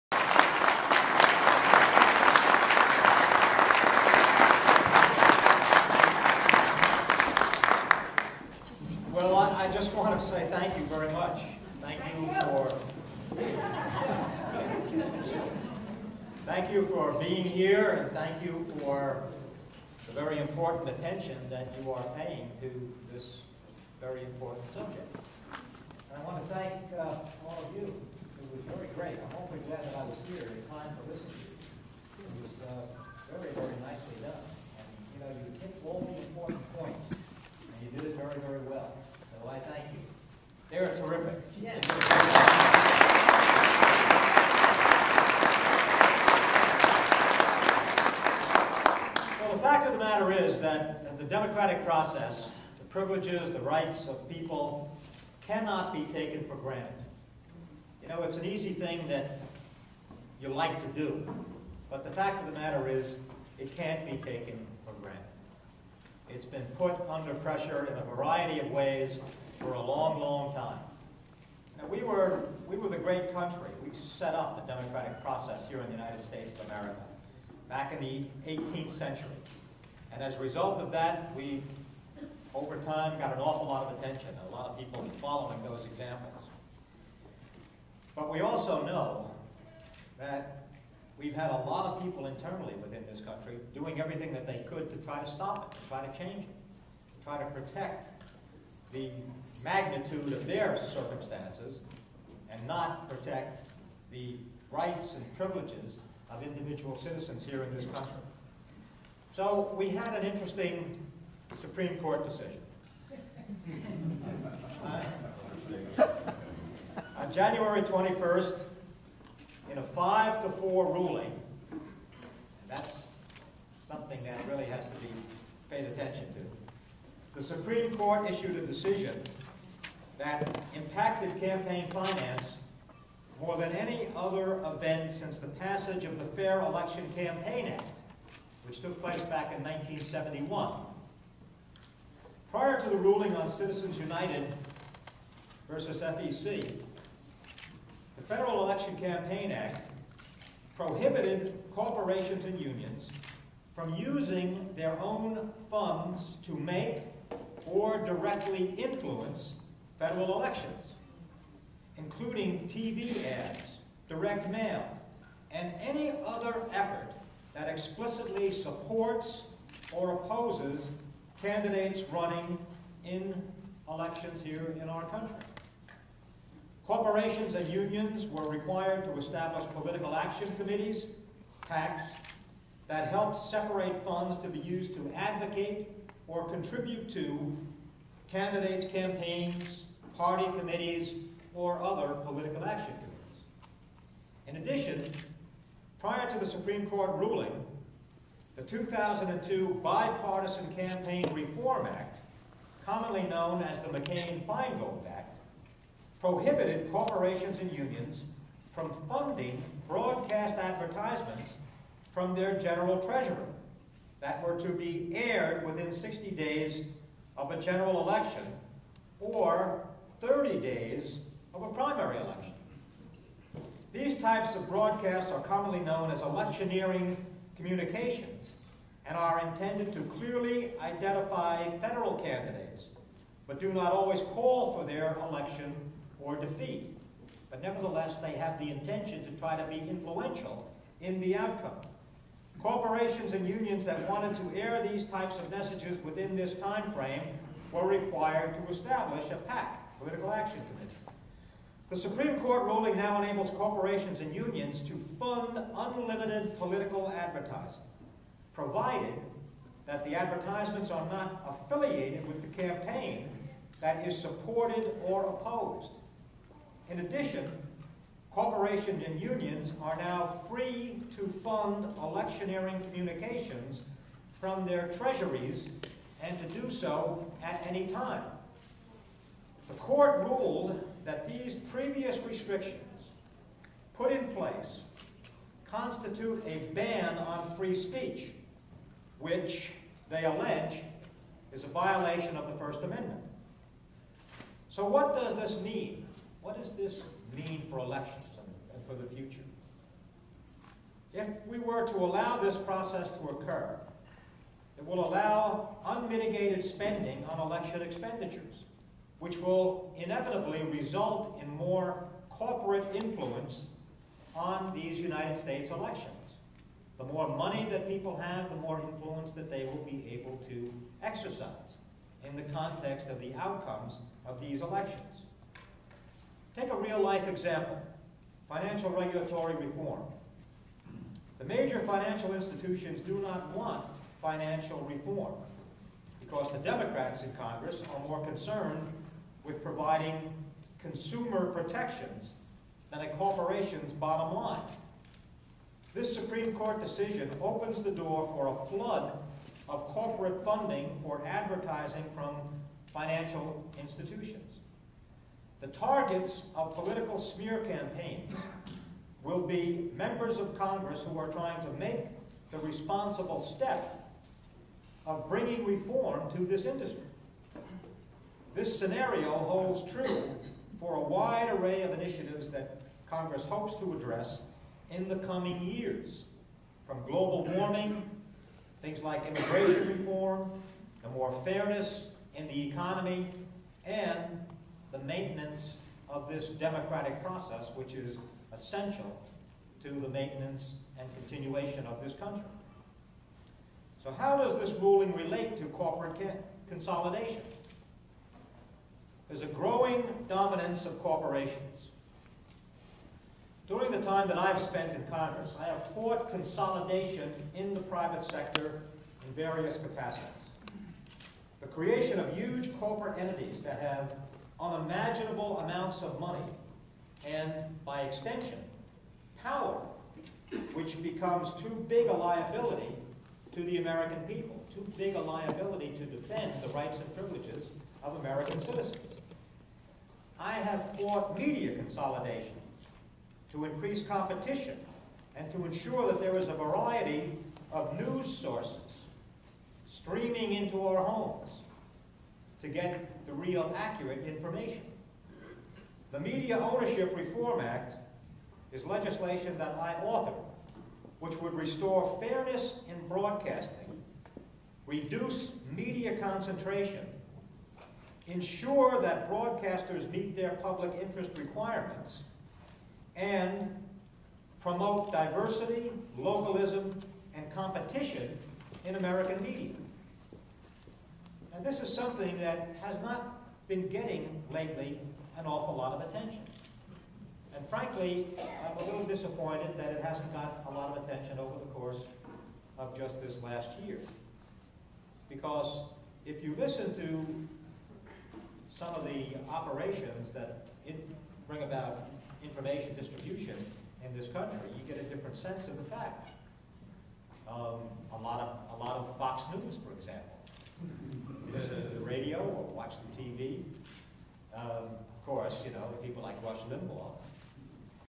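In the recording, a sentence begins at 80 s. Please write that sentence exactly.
And as a result of that, we, over time, got an awful lot of attention, a lot of people following those examples.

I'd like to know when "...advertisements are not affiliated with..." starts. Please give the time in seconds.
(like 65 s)
260 s.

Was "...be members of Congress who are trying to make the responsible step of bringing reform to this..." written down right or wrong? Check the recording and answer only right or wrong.
right.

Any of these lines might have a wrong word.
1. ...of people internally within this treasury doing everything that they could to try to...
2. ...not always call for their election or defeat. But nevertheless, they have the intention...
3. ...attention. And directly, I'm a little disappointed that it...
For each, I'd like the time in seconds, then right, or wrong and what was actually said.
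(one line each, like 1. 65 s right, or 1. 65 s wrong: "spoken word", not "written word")
1. 91 s wrong: "country", not "treasury"
2. 233 s right
3. 476 s wrong: "frankly", not "directly".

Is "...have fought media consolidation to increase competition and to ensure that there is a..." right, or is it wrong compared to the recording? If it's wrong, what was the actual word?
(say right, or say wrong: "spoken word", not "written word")
right.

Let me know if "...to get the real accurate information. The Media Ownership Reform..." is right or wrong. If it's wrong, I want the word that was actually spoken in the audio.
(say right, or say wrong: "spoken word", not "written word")
right.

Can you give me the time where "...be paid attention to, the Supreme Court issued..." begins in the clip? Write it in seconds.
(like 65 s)
124 s.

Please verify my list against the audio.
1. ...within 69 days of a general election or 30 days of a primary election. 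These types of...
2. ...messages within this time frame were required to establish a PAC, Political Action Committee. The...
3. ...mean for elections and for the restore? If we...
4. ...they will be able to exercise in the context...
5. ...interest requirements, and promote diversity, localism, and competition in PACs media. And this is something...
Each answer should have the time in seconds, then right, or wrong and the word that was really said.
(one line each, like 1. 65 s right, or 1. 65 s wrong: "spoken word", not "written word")
1. 215 s wrong: "60", not "69"
2. 245 s right
3. 297 s wrong: "future", not "restore"
4. 319 s right
5. 461 s wrong: "American", not "PACs".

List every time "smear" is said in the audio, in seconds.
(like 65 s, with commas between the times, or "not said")
357 s.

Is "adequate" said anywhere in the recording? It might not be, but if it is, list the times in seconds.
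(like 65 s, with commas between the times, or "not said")
not said.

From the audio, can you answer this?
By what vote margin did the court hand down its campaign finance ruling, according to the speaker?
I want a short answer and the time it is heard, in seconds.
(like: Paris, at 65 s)
5 to 4, at 119 s.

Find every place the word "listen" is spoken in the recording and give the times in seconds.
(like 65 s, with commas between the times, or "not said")
31 s, 486 s, 501 s.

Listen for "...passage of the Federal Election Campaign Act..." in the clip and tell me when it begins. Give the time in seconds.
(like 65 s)
135 s.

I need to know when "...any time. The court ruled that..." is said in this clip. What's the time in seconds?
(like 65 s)
277 s.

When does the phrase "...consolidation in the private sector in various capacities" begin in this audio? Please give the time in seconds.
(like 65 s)
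406 s.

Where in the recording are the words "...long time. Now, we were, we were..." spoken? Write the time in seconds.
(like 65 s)
70 s.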